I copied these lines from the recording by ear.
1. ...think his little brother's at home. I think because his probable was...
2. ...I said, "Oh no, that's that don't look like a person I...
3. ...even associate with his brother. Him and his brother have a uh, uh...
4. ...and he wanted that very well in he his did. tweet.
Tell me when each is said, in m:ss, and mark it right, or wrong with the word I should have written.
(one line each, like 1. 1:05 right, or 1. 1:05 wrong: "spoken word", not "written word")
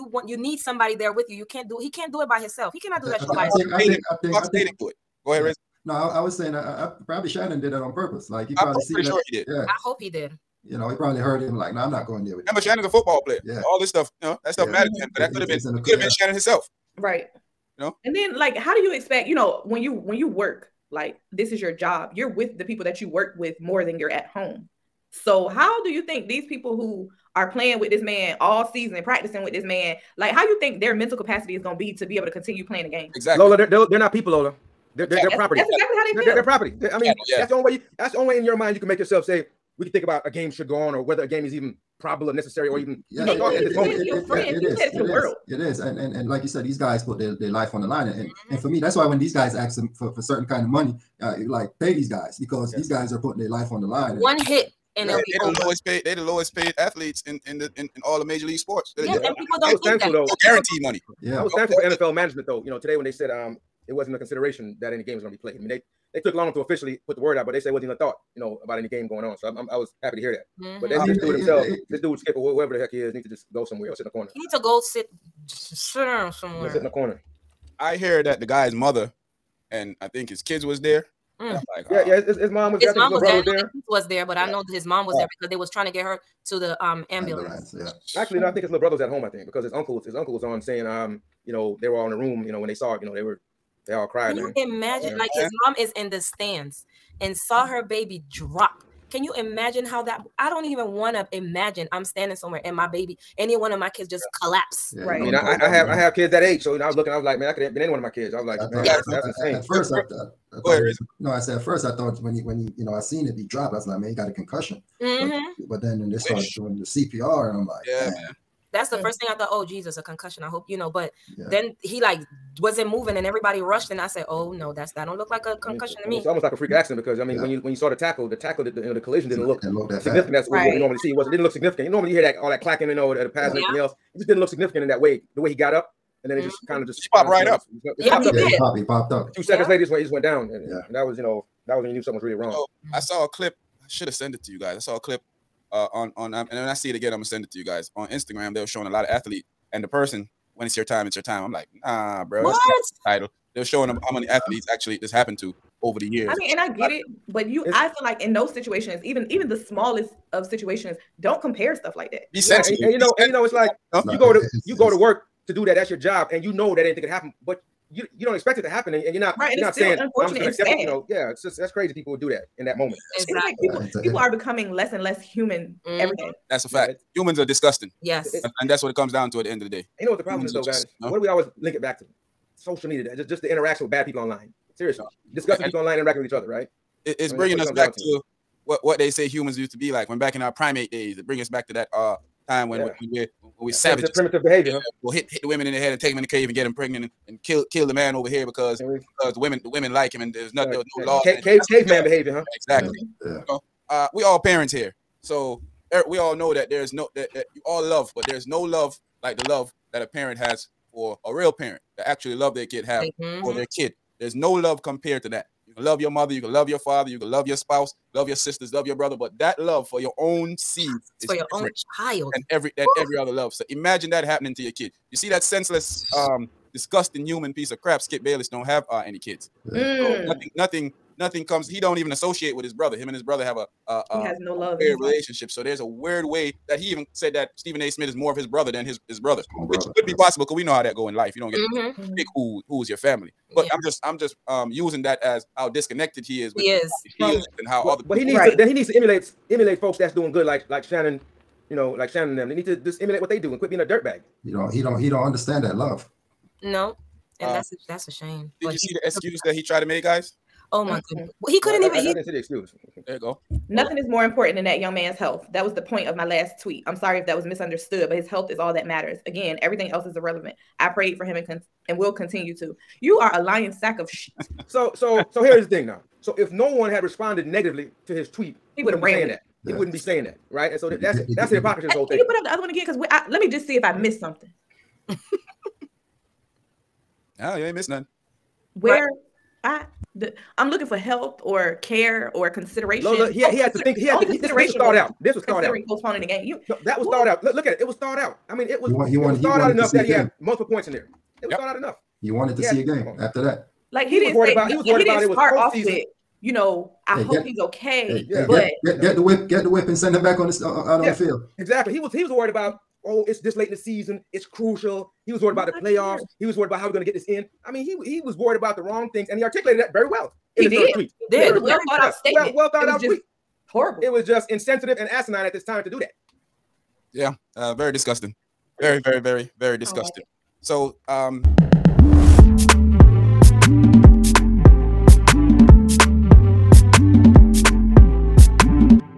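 1. 1:28 wrong: "uncle", not "probable"
2. 2:03 wrong: "concussion", not "person"
3. 3:51 right
4. 5:19 wrong: "articulated", not "wanted".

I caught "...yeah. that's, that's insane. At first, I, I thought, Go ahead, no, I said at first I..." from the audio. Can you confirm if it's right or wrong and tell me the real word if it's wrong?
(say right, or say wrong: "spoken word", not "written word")
right.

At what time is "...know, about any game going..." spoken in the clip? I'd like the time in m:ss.
1:08.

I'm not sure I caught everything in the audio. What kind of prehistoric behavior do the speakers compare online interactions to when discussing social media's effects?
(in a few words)
Caveman behavior.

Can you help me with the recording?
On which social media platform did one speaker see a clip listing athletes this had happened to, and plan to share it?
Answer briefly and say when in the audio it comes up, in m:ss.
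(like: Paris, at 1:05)
Instagram, at 2:28.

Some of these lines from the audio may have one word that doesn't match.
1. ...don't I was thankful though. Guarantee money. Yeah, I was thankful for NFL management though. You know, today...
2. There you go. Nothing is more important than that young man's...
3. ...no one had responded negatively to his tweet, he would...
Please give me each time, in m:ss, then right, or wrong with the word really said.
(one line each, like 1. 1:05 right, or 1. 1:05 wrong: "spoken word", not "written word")
1. 0:59 right
2. 4:23 right
3. 4:36 right.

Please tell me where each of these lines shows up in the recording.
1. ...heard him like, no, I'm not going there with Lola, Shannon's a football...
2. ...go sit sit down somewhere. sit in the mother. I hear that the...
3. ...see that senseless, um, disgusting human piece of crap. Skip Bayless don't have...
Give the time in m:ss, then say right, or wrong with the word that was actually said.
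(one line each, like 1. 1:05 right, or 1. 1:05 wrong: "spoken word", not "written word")
1. 0:11 wrong: "Remember", not "Lola"
2. 1:14 wrong: "corner", not "mother"
3. 3:45 right.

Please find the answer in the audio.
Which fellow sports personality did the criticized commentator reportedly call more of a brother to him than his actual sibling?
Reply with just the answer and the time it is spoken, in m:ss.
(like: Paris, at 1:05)
Stephen A. Smith, at 3:57.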